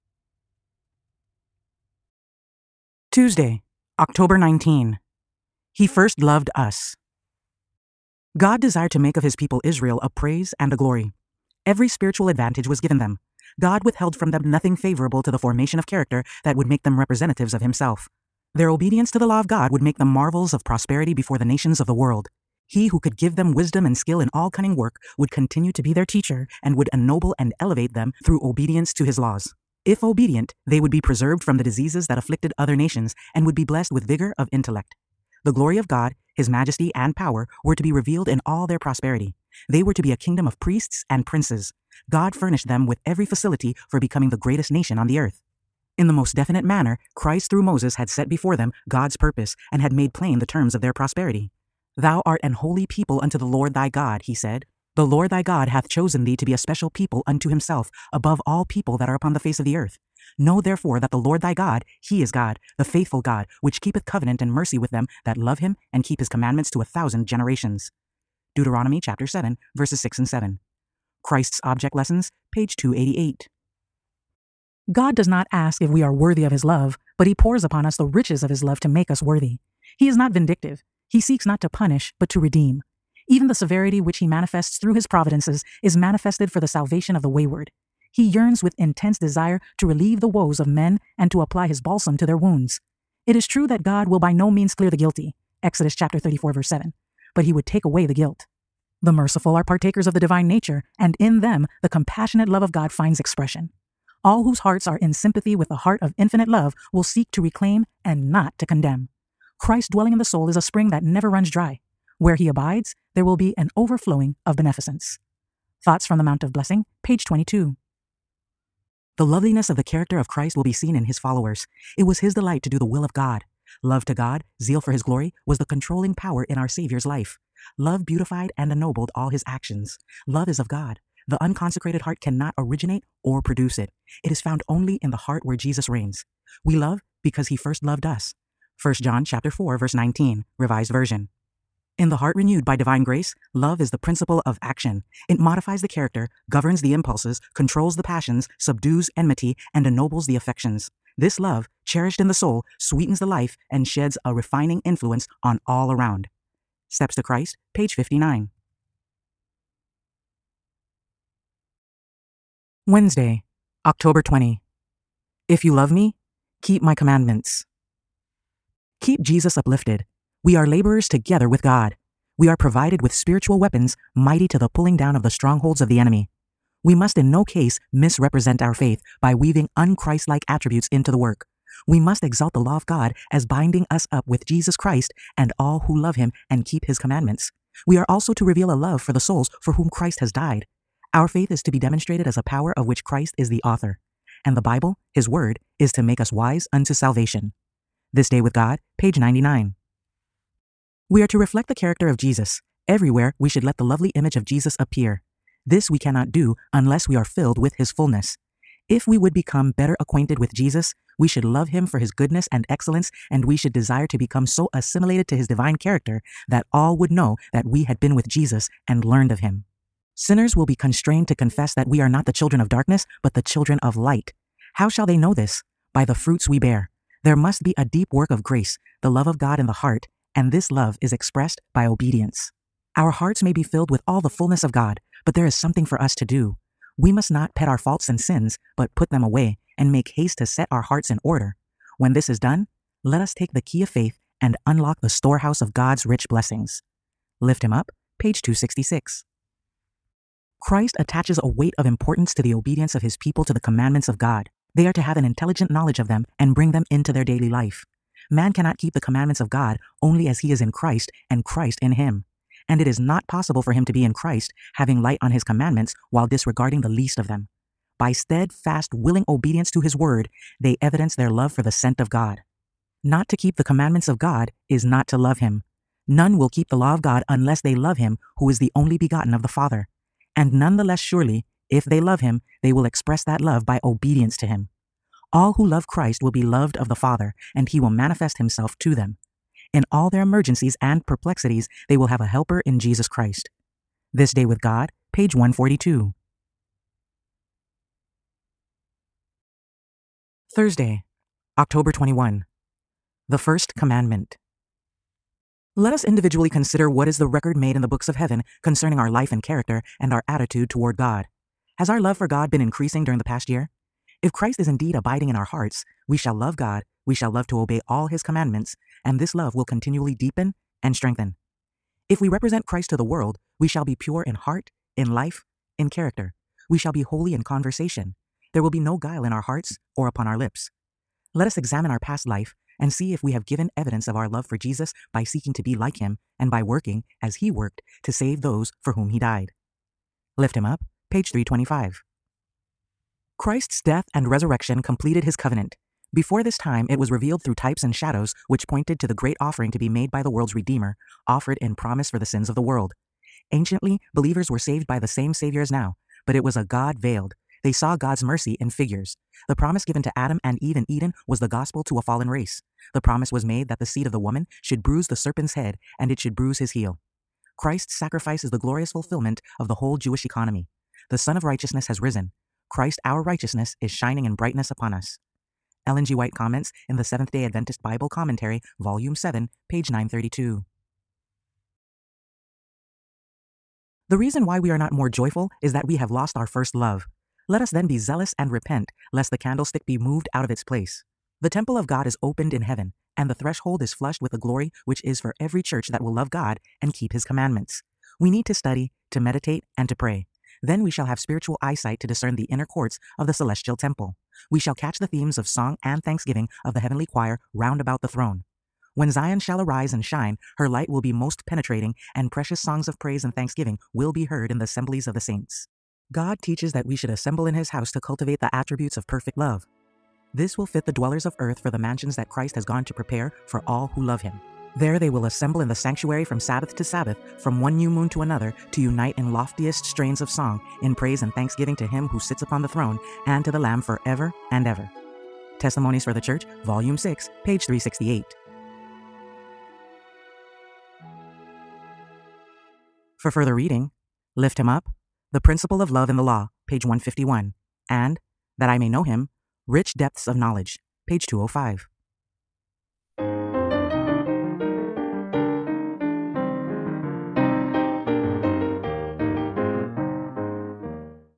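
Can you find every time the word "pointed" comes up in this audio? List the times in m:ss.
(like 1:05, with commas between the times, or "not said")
5:48.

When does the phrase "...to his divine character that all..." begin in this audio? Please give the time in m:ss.
3:35.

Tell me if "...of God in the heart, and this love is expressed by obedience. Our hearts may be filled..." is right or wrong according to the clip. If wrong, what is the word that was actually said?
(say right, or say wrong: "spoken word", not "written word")
right.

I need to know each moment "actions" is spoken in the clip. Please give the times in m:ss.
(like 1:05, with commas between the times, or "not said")
2:09, 2:24.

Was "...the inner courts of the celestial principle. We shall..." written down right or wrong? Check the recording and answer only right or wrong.
wrong.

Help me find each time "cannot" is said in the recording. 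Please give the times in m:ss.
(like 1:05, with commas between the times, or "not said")
2:12, 3:25, 4:18.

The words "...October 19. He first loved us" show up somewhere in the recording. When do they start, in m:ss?
0:03.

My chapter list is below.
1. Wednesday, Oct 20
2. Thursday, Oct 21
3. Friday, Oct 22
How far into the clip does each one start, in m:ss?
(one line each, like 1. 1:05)
1. 2:42
2. 4:59
3. 7:22.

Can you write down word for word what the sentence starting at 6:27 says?
Let us then be zealous and repent, lest the candlestick be moved out of its place.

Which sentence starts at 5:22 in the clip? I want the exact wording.
If we represent Christ to the world, we shall be pure in heart, in life, in character.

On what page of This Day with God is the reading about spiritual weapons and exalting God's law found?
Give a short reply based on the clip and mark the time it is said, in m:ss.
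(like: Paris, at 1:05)
99, at 3:18.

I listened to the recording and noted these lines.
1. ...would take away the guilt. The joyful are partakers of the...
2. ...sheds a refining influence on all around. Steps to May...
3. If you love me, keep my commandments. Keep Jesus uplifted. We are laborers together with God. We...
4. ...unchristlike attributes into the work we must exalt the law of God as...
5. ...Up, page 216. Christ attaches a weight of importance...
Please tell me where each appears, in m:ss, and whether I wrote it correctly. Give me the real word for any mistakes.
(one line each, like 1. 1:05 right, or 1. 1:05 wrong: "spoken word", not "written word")
1. 1:37 wrong: "merciful", not "joyful"
2. 2:33 wrong: "Christ", not "May"
3. 2:45 right
4. 2:59 right
5. 4:07 wrong: "266", not "216".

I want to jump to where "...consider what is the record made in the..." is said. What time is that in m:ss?
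5:06.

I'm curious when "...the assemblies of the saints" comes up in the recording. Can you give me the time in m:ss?
6:54.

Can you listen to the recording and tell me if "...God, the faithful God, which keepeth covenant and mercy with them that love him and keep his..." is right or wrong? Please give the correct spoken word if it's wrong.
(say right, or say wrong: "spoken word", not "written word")
right.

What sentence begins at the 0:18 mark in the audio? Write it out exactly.
Their obedience to the law of God would make them marvels of prosperity before the nations of the world.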